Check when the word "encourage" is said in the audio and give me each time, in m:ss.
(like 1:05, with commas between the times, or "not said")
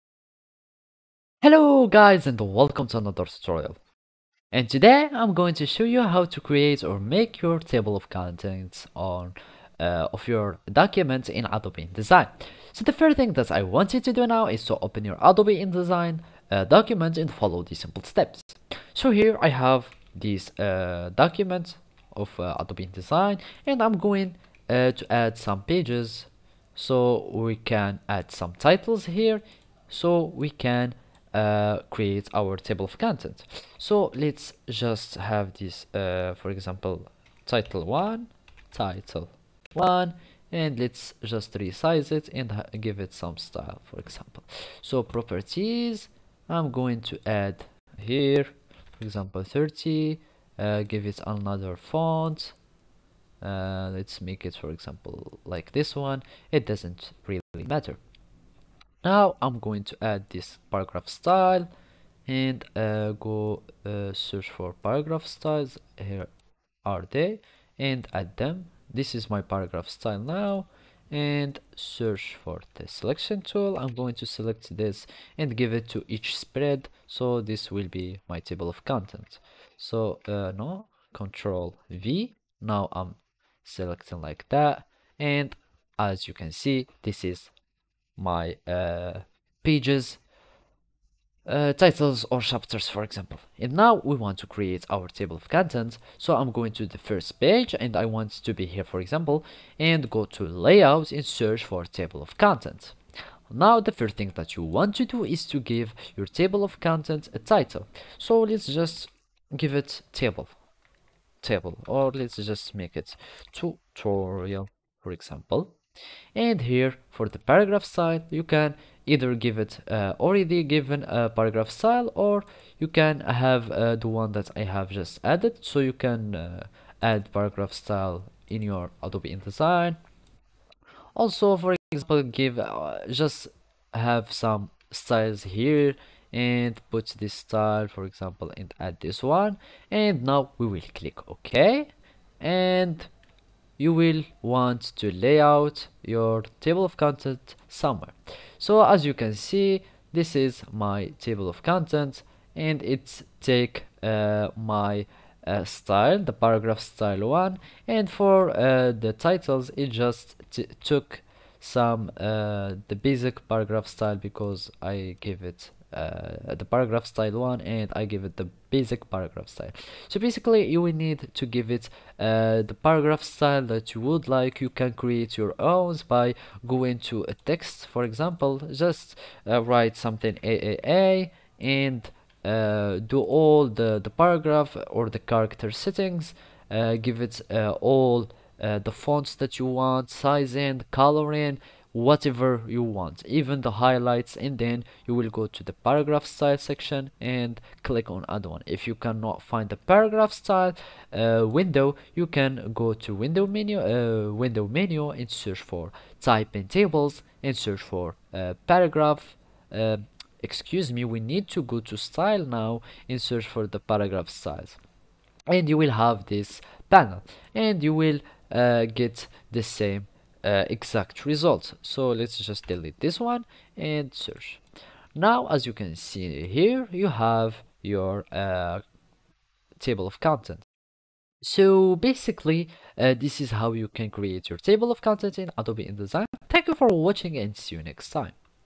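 not said.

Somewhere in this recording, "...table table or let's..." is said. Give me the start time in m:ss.
1:50.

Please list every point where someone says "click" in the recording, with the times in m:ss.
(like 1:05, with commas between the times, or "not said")
2:20, 3:17.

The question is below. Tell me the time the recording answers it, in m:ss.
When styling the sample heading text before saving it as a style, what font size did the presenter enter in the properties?
0:49.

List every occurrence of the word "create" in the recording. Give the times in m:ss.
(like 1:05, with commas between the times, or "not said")
0:06, 0:31, 1:34, 2:54, 3:54.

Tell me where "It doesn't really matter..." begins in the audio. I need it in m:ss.
0:56.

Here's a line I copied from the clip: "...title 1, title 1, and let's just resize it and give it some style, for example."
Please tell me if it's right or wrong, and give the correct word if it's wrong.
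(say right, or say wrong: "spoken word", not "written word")
right.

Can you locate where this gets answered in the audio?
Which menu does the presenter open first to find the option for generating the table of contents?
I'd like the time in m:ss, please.
1:40.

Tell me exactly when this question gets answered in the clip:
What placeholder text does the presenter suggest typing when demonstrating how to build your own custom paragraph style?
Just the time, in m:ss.
3:00.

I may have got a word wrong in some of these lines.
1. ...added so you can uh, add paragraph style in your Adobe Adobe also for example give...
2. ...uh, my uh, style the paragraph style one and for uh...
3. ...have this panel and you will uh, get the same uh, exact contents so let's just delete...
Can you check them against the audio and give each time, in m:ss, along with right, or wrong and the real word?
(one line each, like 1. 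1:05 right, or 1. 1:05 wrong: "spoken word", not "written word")
1. 2:05 wrong: "InDesign", not "Adobe"
2. 2:34 right
3. 3:35 wrong: "results", not "contents".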